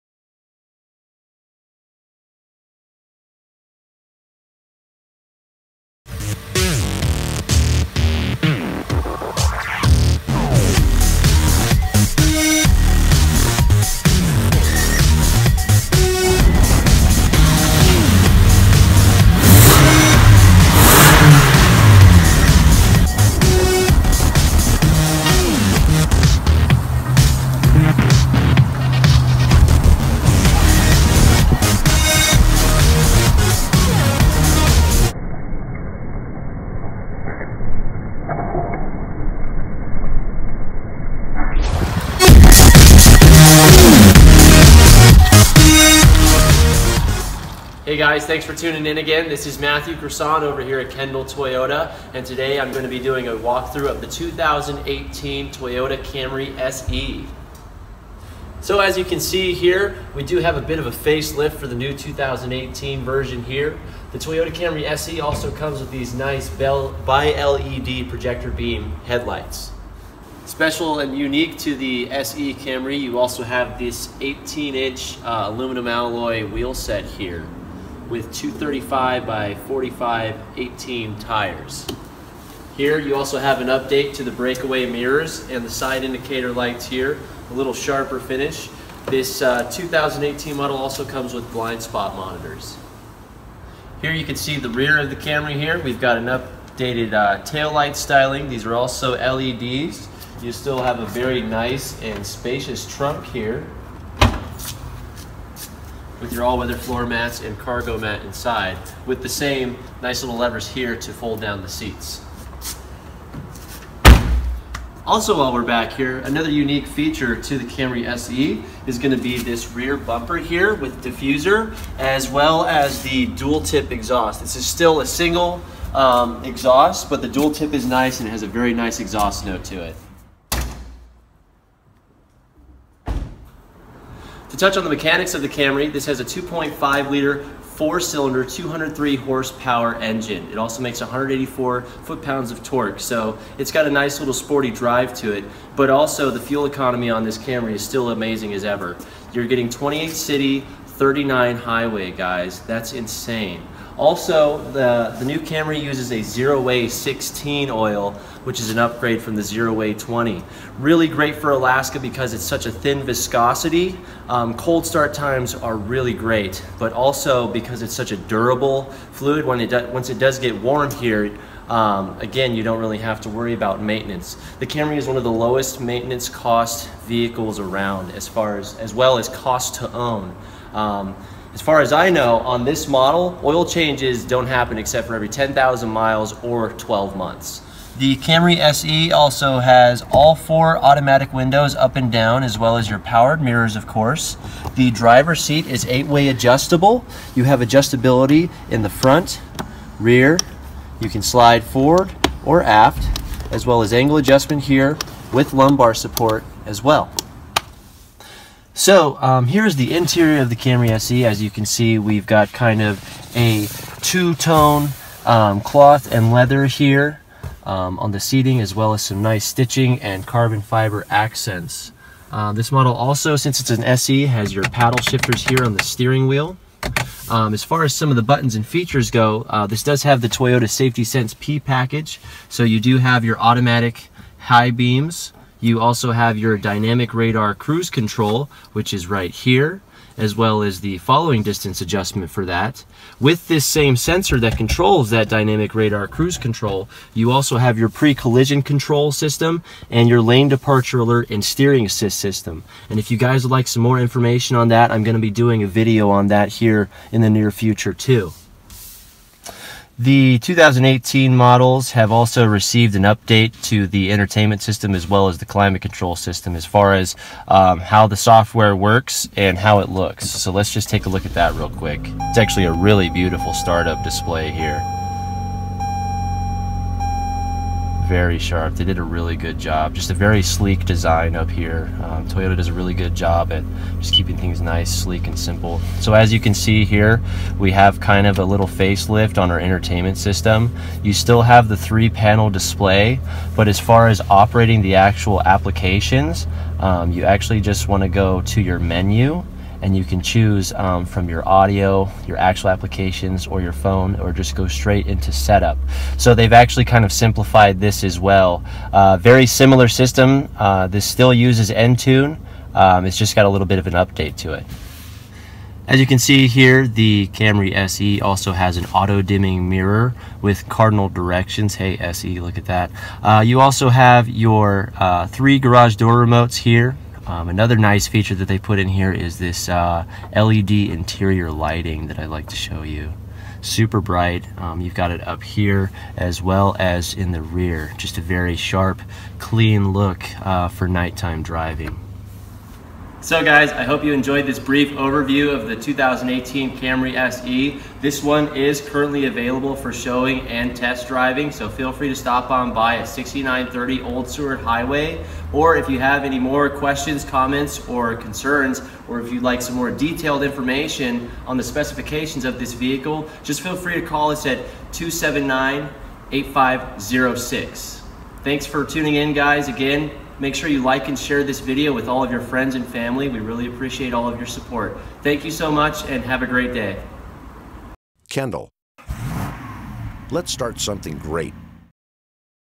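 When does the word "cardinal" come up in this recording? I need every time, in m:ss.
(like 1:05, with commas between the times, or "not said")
5:20.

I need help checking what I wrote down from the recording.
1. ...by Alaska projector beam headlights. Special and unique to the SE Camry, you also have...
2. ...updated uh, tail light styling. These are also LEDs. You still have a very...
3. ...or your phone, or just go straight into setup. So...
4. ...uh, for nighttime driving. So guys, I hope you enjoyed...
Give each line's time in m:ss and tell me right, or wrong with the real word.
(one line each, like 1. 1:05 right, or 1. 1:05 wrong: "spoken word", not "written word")
1. 1:07 wrong: "LED", not "Alaska"
2. 1:36 right
3. 5:03 right
4. 5:40 right.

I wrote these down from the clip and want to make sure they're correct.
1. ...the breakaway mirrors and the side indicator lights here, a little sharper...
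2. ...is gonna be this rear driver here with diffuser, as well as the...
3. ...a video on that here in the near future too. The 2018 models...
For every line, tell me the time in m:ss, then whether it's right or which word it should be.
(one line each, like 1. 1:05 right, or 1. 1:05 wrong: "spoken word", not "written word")
1. 1:24 right
2. 1:58 wrong: "bumper", not "driver"
3. 4:15 right.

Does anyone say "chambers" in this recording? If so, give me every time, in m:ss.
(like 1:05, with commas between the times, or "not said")
not said.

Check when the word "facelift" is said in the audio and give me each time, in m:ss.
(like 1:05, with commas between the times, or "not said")
1:00, 4:48.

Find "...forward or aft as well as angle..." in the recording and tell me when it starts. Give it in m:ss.
3:21.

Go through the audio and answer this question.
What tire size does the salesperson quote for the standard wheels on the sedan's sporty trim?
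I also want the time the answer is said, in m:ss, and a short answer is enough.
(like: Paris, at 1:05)
235/45 18, at 1:18.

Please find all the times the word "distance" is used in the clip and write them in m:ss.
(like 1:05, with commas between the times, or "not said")
4:01.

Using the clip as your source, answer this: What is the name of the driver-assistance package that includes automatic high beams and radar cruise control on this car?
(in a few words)
Toyota Safety Sense P.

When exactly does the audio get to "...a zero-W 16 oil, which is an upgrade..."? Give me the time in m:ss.
2:36.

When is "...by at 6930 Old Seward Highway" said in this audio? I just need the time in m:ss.
5:52.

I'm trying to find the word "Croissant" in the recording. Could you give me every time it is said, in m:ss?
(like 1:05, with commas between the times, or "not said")
0:49.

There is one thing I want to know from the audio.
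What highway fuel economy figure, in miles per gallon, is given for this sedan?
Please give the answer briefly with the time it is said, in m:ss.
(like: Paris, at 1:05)
39, at 2:30.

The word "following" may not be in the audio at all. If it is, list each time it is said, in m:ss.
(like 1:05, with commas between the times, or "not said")
4:00.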